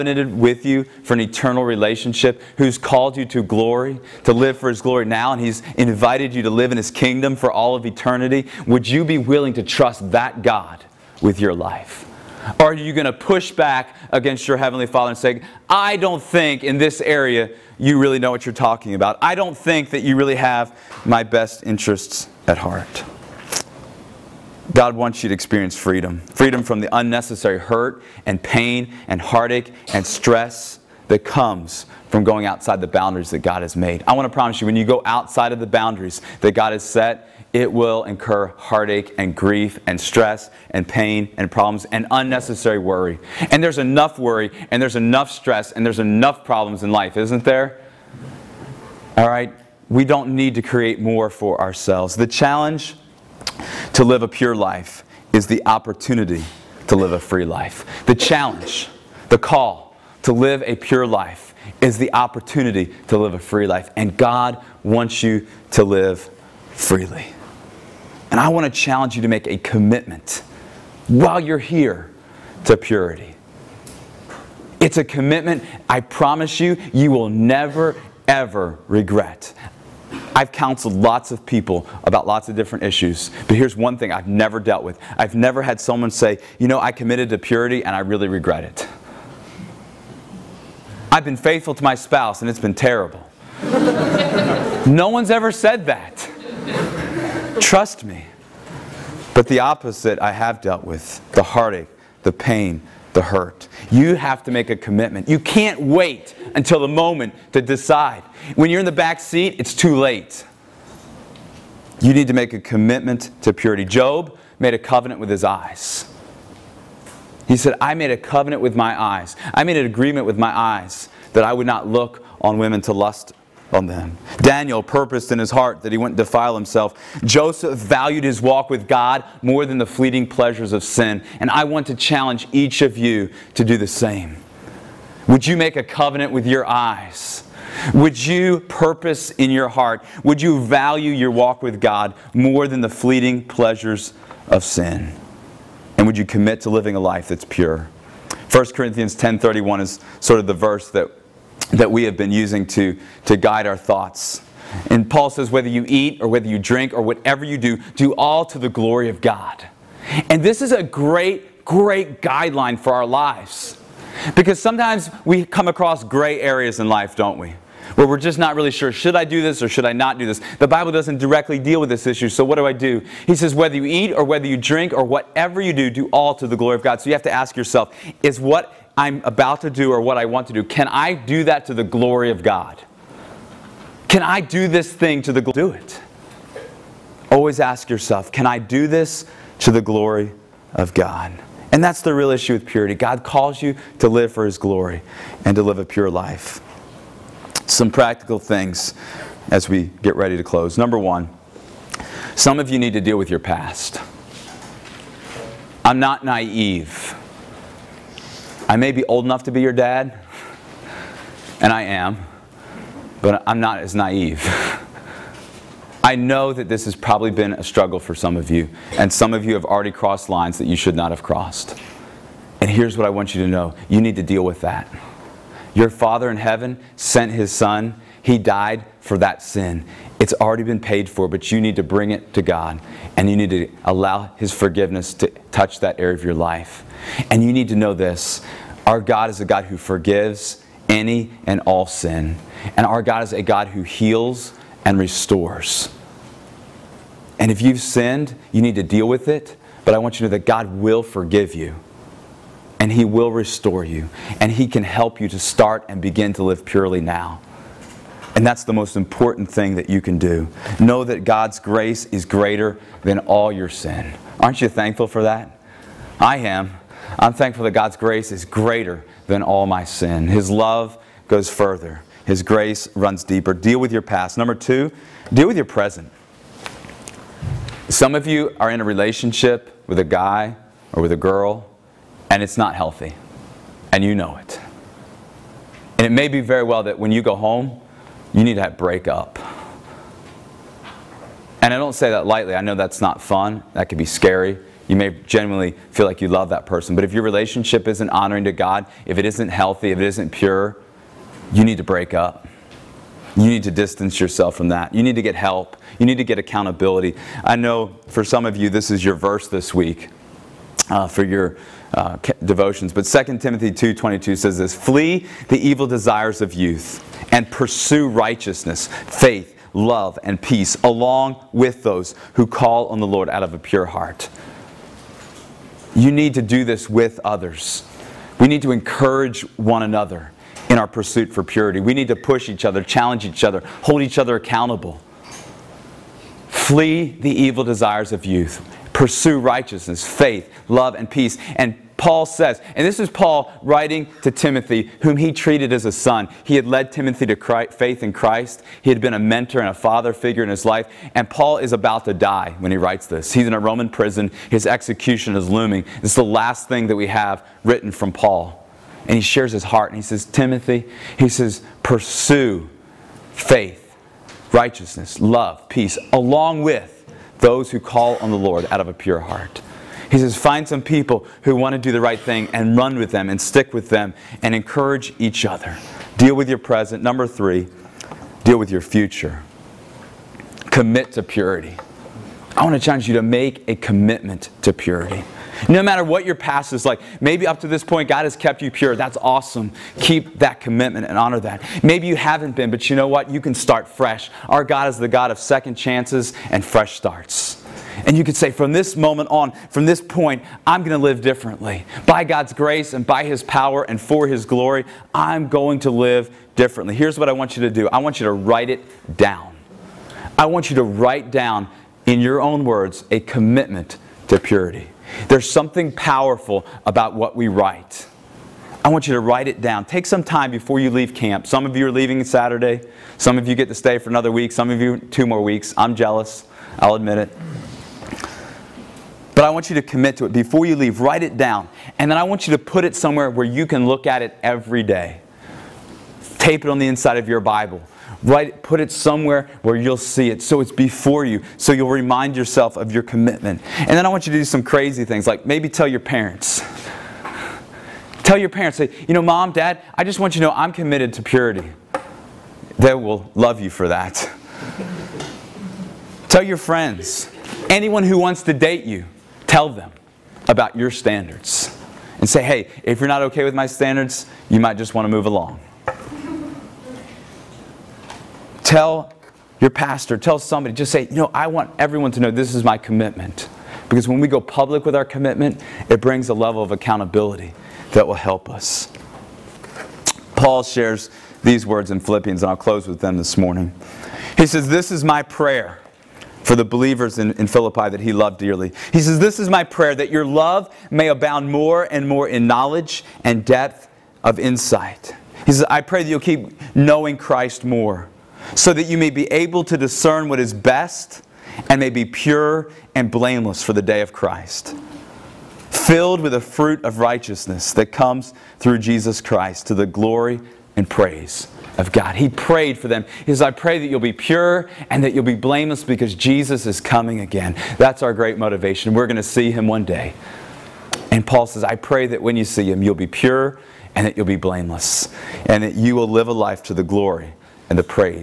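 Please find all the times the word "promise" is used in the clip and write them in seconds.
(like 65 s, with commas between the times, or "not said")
34 s, 76 s.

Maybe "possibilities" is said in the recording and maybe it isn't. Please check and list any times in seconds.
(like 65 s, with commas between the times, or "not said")
not said.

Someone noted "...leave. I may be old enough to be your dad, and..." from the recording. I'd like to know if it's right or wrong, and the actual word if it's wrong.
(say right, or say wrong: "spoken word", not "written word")
wrong: "naive", not "leave".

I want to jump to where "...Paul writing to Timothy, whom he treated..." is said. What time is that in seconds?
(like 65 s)
343 s.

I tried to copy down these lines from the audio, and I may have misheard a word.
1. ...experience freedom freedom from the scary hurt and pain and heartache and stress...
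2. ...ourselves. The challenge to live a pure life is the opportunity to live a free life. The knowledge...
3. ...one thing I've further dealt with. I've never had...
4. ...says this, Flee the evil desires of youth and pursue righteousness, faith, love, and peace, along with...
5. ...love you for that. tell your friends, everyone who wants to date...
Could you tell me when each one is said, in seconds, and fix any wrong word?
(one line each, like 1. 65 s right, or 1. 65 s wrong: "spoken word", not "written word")
1. 25 s wrong: "unnecessary", not "scary"
2. 51 s wrong: "challenge", not "knowledge"
3. 83 s wrong: "never", not "further"
4. 314 s right
5. 453 s wrong: "anyone", not "everyone".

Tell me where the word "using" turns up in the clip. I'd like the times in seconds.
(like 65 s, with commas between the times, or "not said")
152 s.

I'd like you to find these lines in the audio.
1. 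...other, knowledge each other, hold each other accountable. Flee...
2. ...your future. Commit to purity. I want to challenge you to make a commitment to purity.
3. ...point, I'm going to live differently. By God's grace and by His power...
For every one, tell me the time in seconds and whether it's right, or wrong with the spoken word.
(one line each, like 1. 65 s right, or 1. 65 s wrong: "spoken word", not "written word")
1. 332 s wrong: "challenge", not "knowledge"
2. 378 s right
3. 400 s right.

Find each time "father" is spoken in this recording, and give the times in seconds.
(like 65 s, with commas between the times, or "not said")
14 s, 225 s, 349 s.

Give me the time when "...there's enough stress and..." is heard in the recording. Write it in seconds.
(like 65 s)
44 s.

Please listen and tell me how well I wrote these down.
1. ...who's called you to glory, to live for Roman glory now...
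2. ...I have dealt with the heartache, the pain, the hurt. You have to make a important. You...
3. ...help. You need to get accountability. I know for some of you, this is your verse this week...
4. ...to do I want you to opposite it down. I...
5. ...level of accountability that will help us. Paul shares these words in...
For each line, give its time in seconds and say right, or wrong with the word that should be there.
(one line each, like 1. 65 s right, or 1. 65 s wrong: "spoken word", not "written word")
1. 2 s wrong: "His", not "Roman"
2. 100 s wrong: "commitment", not "important"
3. 305 s right
4. 407 s wrong: "write", not "opposite"
5. 476 s right.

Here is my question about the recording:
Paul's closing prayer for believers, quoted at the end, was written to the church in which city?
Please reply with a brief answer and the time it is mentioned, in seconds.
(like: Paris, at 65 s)
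Philippi, at 487 s.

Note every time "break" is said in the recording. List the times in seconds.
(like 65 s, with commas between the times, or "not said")
288 s, 301 s.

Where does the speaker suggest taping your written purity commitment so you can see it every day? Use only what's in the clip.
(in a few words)
Inside of your Bible.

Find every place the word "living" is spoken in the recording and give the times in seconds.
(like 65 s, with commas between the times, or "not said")
146 s.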